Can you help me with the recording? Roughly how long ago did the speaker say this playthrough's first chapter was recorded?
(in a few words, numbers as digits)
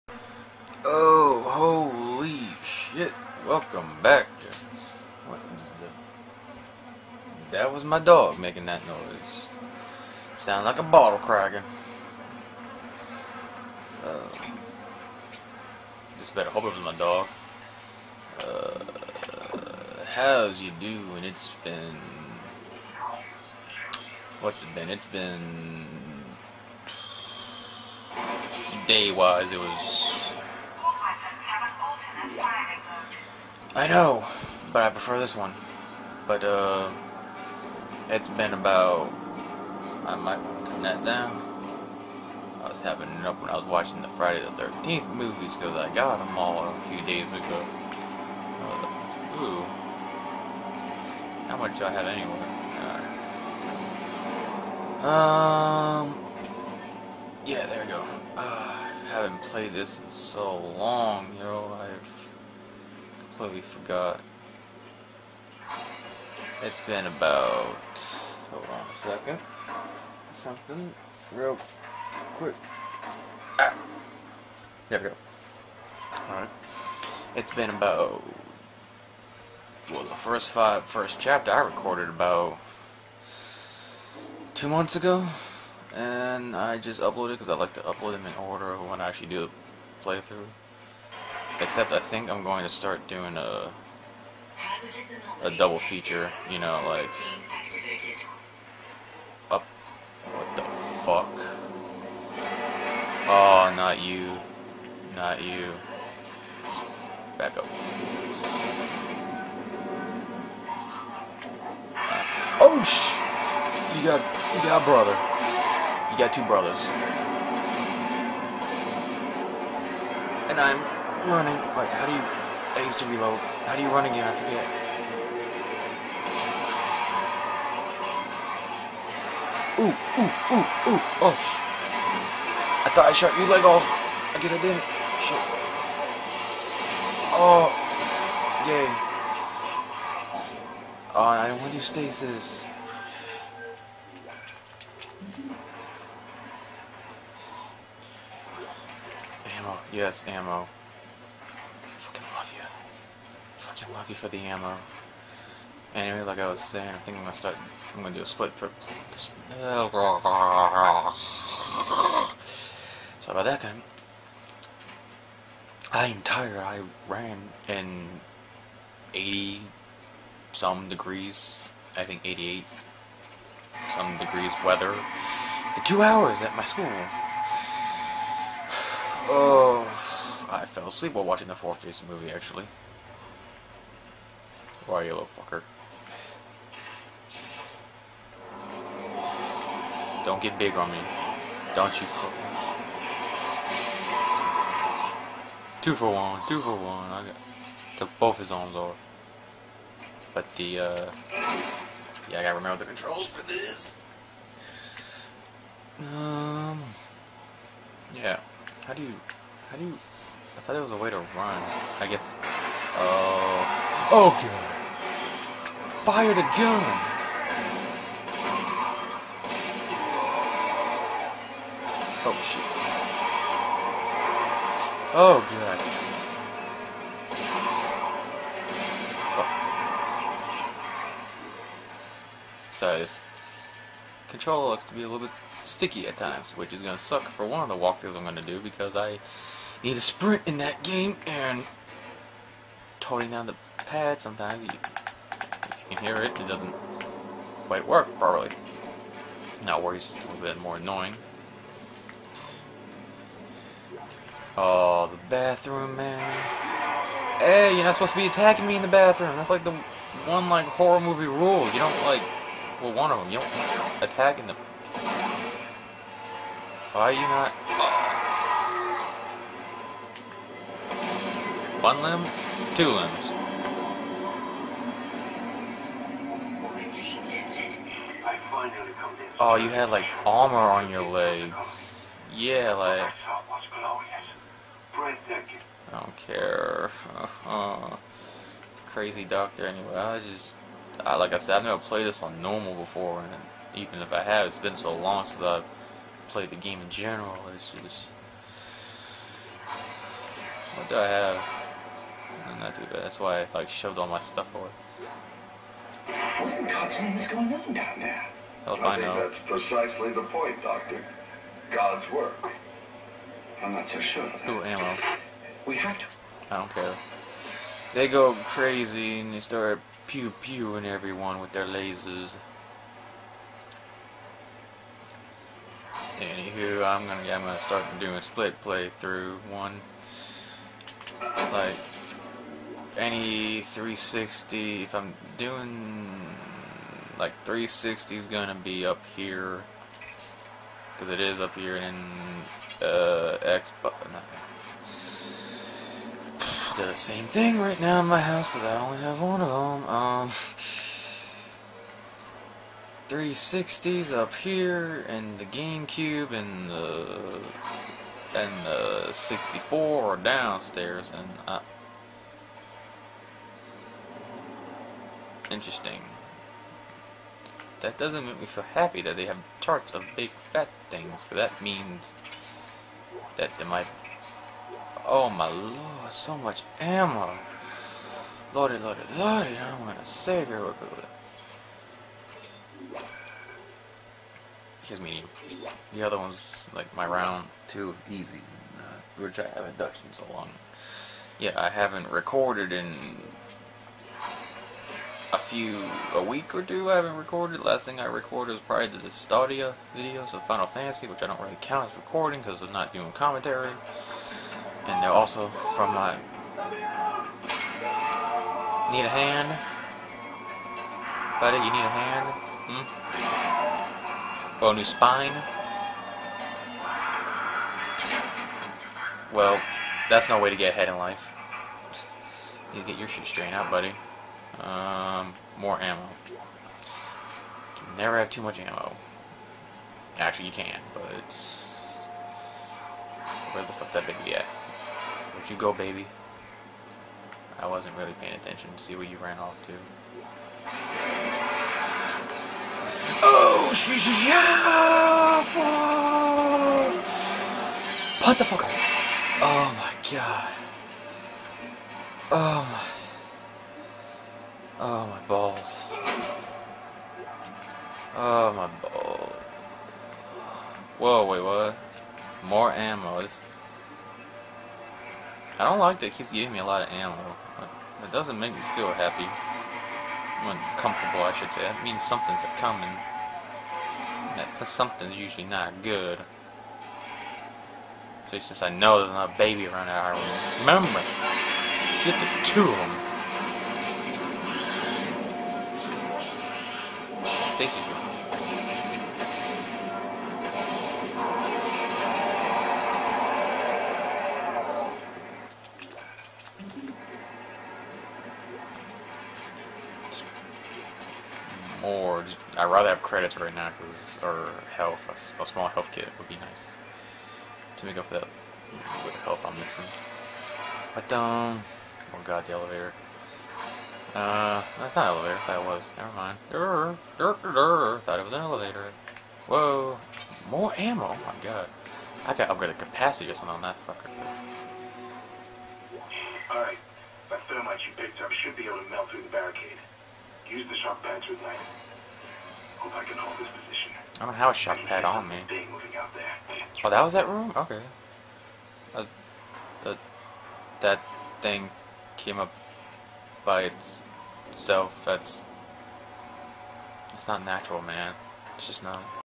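about 2 months.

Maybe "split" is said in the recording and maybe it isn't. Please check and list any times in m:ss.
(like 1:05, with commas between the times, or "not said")
2:38, 5:28.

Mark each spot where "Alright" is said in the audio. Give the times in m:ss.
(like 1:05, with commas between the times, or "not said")
1:16, 8:46.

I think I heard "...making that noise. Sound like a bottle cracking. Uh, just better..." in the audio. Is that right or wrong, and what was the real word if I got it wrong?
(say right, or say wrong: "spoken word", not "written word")
right.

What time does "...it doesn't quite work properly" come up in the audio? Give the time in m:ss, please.
4:06.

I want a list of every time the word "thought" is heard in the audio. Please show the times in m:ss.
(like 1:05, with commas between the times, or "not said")
2:12, 3:30, 8:38.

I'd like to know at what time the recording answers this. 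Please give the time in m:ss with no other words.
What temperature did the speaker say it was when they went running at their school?
2:52.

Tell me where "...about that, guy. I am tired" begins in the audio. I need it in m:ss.
2:43.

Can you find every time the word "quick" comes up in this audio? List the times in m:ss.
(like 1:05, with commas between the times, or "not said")
1:12.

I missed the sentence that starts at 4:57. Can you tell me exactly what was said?
It's just, what do I have?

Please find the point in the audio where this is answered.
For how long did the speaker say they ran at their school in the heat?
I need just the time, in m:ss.
2:55.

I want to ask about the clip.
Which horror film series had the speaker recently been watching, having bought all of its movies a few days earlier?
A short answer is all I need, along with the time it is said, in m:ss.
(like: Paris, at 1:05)
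Friday the 13th, at 0:44.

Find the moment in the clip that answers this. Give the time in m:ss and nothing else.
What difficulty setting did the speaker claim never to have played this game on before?
4:52.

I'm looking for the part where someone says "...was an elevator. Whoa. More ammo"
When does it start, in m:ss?
8:38.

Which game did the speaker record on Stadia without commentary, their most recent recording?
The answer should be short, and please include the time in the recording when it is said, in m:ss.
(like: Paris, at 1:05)
Final Fantasy, at 6:40.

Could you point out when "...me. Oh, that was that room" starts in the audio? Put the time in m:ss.
8:55.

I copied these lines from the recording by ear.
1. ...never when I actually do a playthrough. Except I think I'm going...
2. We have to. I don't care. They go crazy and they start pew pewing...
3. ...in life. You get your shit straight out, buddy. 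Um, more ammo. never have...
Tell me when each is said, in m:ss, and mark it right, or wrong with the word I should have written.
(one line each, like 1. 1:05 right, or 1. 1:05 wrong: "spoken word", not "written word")
1. 1:28 wrong: "order", not "never"
2. 5:15 right
3. 7:00 right.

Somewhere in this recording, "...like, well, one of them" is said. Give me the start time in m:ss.
4:22.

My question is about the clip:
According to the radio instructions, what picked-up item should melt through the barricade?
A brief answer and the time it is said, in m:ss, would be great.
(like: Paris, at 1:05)
thermite, at 8:47.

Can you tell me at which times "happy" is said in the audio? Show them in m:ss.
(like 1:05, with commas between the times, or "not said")
6:08, 7:48.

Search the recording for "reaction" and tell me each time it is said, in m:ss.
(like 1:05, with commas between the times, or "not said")
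not said.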